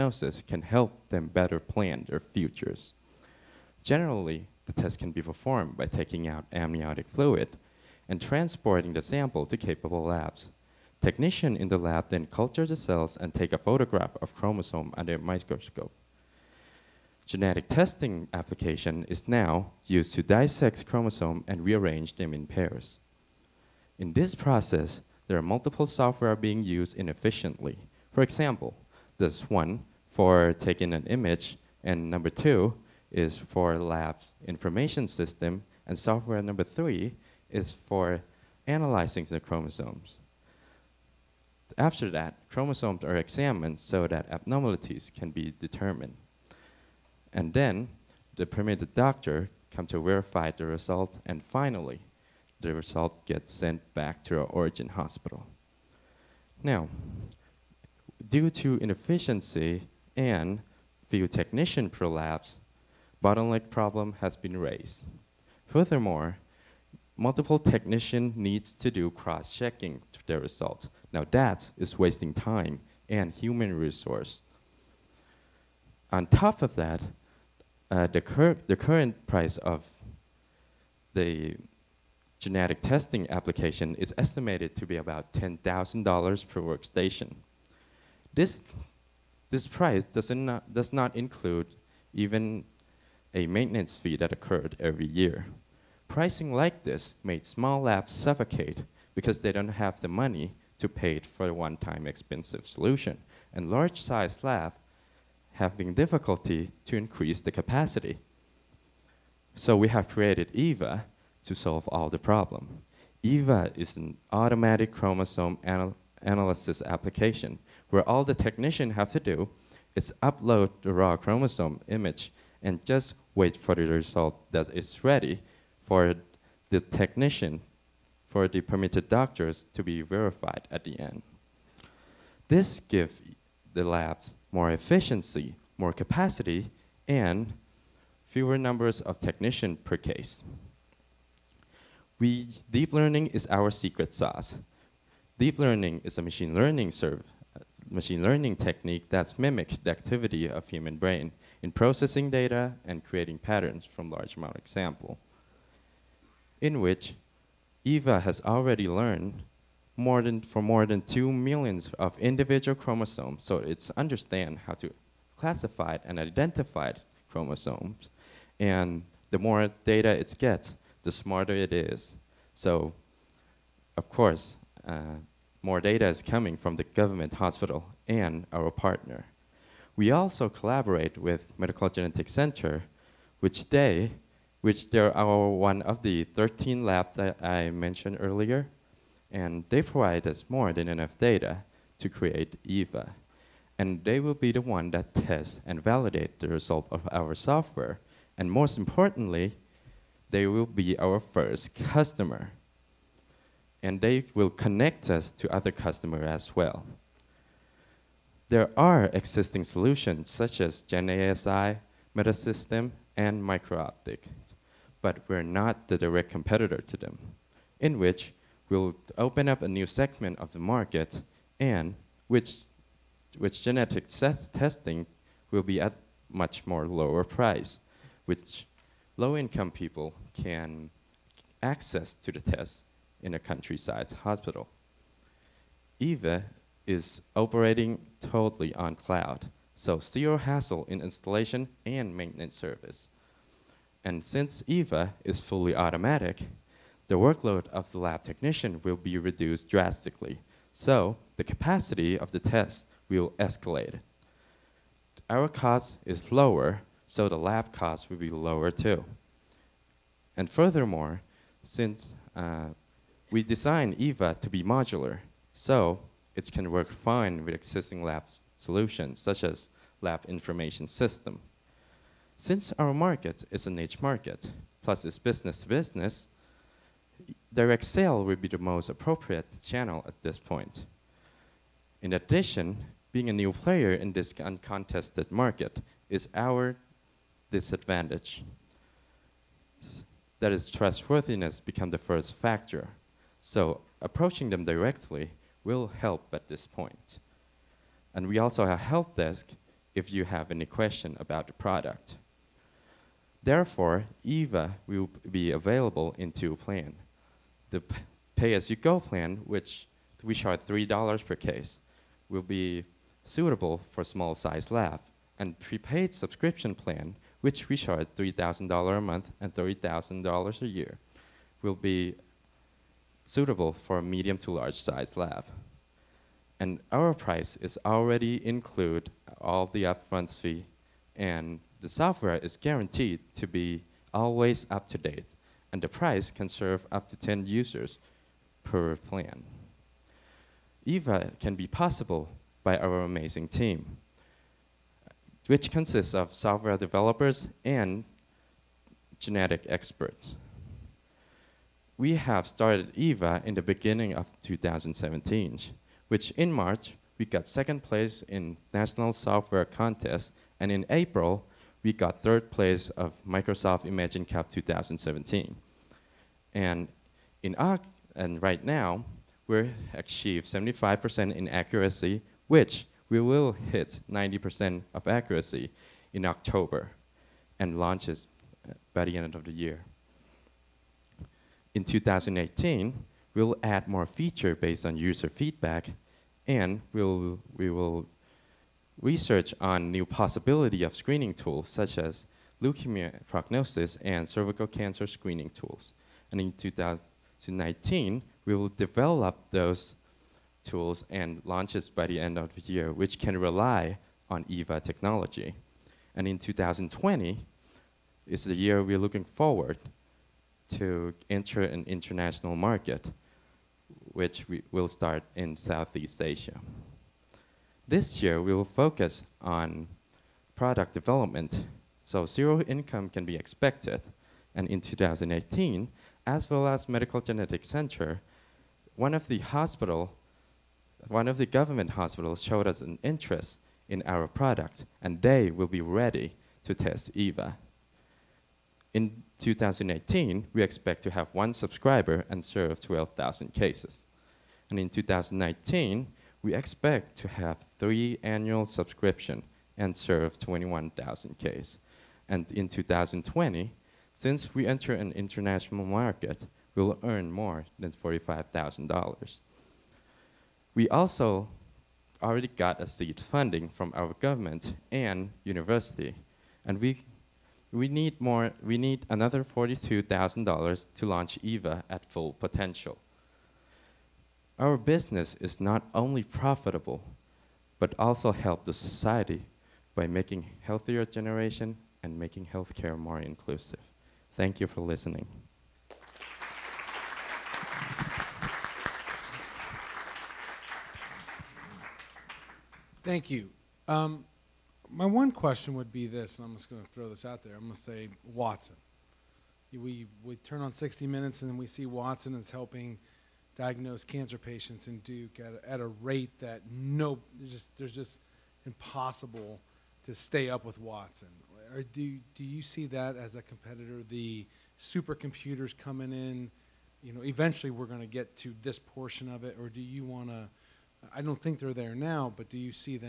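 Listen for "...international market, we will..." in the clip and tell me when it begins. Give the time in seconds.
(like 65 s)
455 s.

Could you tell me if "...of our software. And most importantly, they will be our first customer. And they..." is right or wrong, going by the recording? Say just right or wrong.
right.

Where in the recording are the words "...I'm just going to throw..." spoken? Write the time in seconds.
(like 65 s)
496 s.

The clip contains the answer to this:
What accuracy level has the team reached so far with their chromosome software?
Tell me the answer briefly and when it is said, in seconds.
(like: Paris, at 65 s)
75%, at 370 s.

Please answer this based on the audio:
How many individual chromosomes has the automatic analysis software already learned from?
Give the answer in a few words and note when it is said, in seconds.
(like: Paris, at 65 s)
more than 2 million, at 160 s.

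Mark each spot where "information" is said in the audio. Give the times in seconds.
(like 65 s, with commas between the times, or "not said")
34 s, 270 s.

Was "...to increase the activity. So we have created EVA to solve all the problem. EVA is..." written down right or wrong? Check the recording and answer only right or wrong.
wrong.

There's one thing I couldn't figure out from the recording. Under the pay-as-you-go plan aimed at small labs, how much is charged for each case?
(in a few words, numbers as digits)
$3.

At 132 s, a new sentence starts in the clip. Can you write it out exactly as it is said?
This gives the labs more efficiency, more capacity, and fewer numbers of technicians per case.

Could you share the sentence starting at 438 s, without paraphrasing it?
In 2018, we expect to have one subscriber and serve 12,000 cases.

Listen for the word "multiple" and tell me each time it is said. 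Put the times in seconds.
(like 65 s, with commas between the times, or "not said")
25 s, 67 s.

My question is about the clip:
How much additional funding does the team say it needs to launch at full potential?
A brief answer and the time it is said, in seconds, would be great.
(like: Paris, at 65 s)
$42,000, at 469 s.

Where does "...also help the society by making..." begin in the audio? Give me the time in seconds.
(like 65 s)
477 s.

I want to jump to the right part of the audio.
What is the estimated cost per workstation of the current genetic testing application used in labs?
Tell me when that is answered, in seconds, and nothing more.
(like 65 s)
85 s.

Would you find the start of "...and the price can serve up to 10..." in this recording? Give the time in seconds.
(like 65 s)
335 s.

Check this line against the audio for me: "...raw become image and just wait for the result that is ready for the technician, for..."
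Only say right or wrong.
wrong.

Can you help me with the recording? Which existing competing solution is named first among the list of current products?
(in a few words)
GenASI.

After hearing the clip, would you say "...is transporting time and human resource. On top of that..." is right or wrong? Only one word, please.
wrong.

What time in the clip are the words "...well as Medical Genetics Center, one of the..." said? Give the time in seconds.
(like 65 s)
426 s.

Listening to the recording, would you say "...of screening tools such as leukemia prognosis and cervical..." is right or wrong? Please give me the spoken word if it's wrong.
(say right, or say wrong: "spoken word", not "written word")
right.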